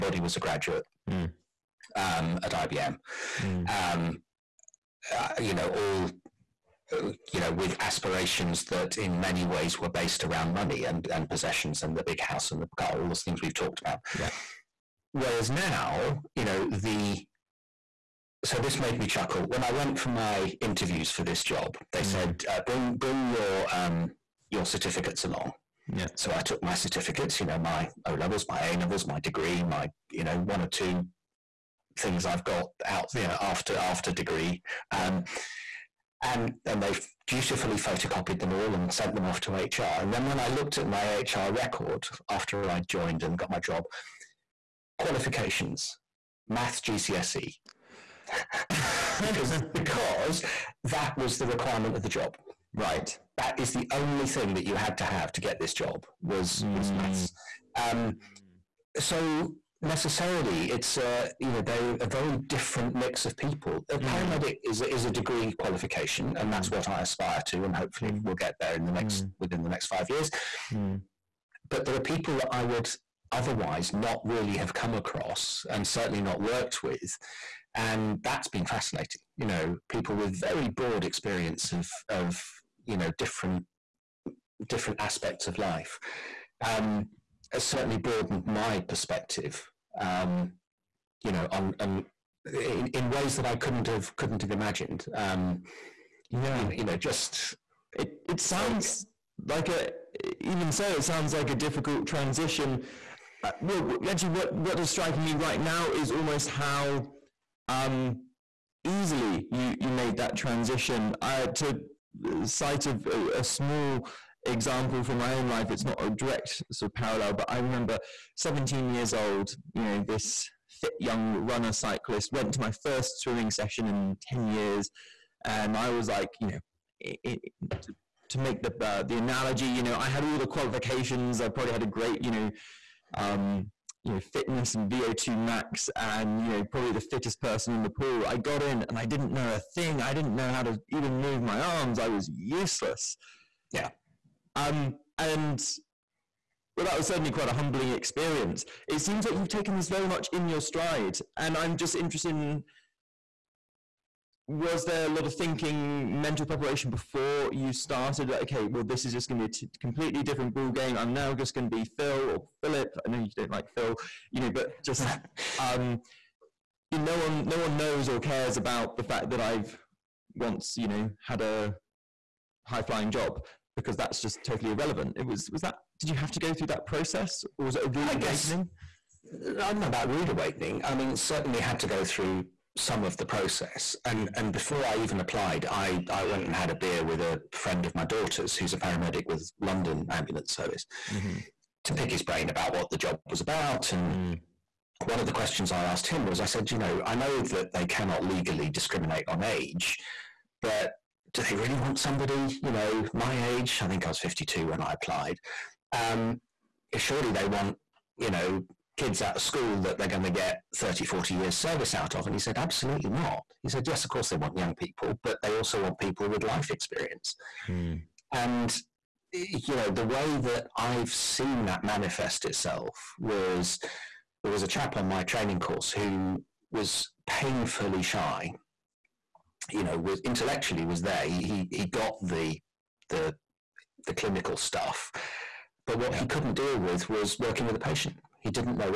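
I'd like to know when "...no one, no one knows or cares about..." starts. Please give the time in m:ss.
2:47.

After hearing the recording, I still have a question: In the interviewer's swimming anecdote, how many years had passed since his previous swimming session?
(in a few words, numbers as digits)
10.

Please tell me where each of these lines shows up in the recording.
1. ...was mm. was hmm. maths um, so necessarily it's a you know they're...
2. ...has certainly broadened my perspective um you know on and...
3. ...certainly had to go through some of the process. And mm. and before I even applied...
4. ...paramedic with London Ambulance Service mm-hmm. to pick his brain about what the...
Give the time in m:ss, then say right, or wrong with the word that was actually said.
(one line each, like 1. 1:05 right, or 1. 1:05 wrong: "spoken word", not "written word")
1. 0:56 right
2. 1:27 right
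3. 3:01 right
4. 3:08 right.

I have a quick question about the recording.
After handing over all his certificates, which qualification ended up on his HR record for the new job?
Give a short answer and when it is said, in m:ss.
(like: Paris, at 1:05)
Maths GCSE, at 0:46.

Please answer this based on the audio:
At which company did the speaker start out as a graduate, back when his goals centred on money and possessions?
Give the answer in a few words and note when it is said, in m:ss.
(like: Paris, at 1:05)
IBM, at 0:02.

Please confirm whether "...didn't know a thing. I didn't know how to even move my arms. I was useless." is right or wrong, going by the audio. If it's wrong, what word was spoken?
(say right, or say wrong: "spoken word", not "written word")
right.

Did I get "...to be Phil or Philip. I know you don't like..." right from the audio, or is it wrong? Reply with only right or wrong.
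right.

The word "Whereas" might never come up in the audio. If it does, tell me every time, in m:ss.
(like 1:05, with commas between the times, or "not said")
0:15.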